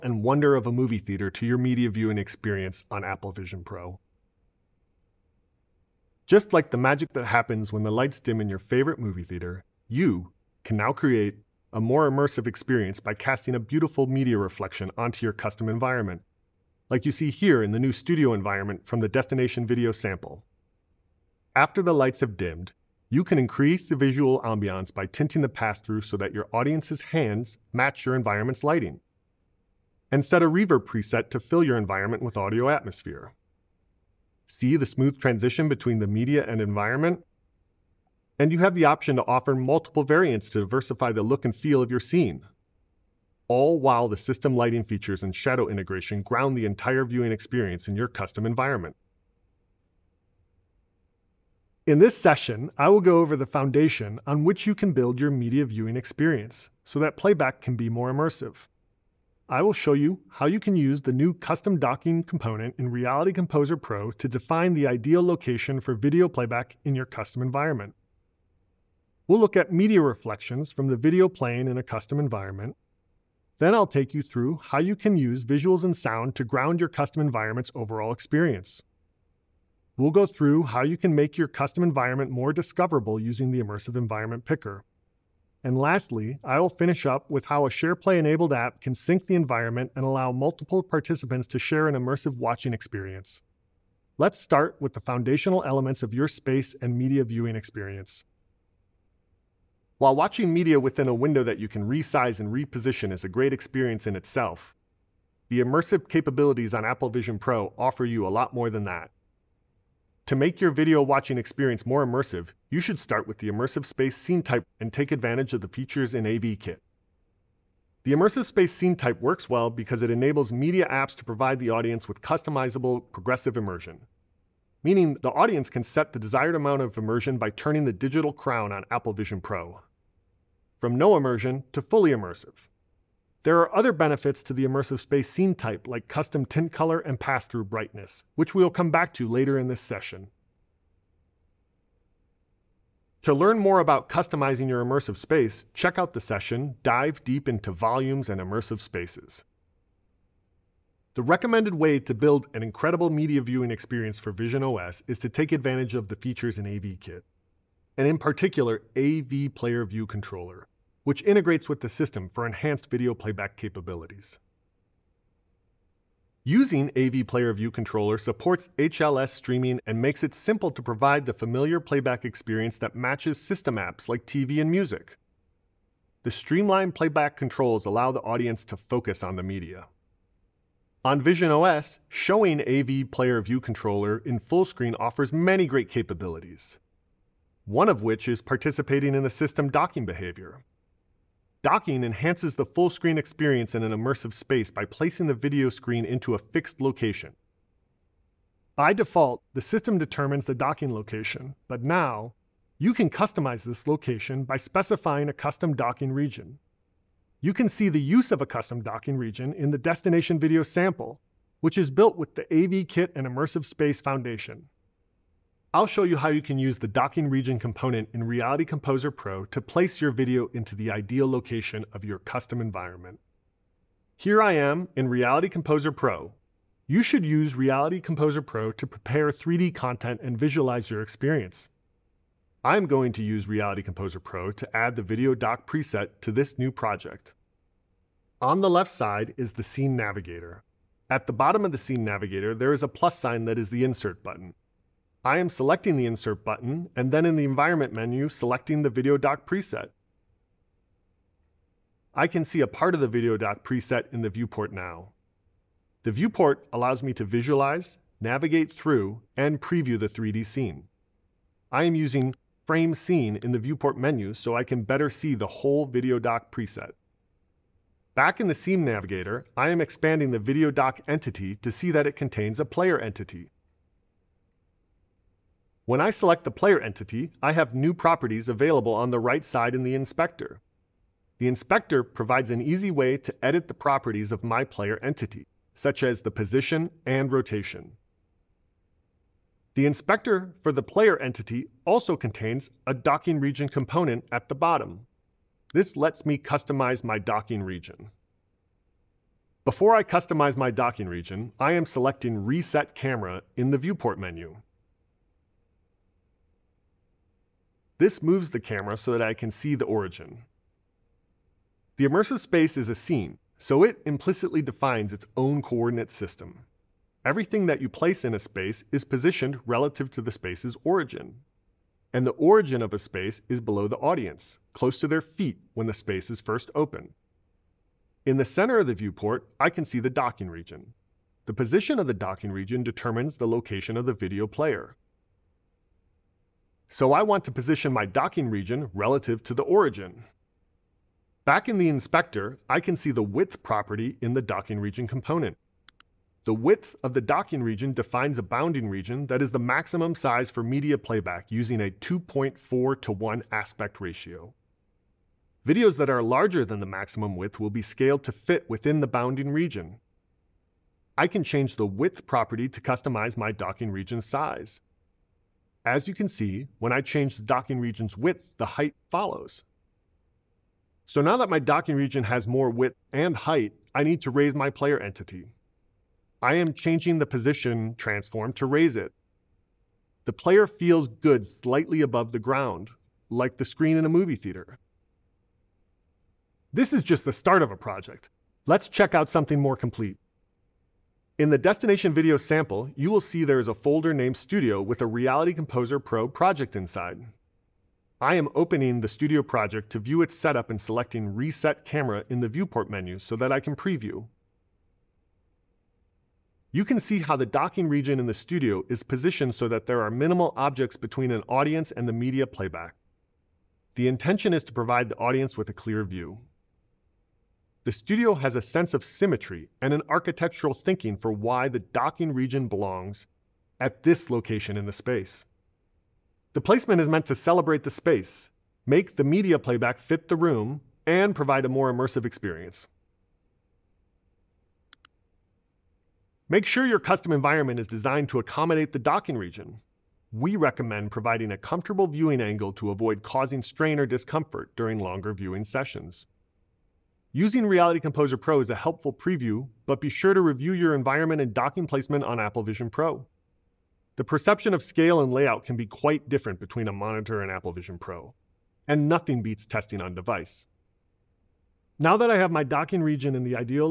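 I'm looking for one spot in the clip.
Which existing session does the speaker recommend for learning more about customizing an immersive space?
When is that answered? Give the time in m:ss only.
2:26.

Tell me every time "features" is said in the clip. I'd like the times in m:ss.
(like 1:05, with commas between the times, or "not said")
0:44, 1:55, 2:36.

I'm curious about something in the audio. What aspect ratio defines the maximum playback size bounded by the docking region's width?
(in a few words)
2.4 to 1.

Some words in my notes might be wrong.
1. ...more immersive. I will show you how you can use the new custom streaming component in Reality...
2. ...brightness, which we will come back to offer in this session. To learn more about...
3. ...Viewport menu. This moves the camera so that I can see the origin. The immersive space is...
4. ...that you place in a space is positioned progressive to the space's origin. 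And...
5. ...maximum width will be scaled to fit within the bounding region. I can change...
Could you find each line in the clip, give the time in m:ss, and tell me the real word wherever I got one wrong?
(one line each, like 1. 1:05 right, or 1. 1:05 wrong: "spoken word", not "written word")
1. 0:57 wrong: "docking", not "streaming"
2. 2:17 wrong: "later", not "offer"
3. 5:03 right
4. 5:17 wrong: "relative", not "progressive"
5. 5:56 right.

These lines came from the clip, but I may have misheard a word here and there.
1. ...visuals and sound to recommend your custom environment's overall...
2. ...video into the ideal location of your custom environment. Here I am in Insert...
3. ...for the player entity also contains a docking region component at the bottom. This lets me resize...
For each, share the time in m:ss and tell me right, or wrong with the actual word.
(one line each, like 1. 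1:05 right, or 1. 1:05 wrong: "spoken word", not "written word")
1. 1:15 wrong: "ground", not "recommend"
2. 3:40 wrong: "Reality", not "Insert"
3. 4:50 wrong: "customize", not "resize".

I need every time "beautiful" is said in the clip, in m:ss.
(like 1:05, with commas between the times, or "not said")
0:13.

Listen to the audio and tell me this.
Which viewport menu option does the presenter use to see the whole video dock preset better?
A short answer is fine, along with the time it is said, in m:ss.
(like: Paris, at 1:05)
Frame Scene, at 4:22.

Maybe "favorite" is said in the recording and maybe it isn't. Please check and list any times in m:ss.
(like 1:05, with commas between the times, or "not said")
0:08.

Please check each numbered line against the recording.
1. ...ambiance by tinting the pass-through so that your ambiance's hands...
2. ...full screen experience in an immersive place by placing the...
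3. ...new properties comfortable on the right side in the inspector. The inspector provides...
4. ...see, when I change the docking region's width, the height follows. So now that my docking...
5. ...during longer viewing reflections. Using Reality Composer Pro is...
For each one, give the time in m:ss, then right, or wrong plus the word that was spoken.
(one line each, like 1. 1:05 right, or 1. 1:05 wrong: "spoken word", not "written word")
1. 0:24 wrong: "audience", not "ambiance"
2. 3:12 wrong: "space", not "place"
3. 4:37 wrong: "available", not "comfortable"
4. 6:06 right
5. 7:24 wrong: "sessions", not "reflections".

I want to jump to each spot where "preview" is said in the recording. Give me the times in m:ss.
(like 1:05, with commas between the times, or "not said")
4:19, 6:43, 7:29.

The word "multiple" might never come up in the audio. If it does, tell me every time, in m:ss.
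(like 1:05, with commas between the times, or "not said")
0:39, 1:30.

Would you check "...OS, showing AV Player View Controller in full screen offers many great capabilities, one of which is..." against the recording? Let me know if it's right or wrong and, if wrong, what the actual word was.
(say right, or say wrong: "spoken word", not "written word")
right.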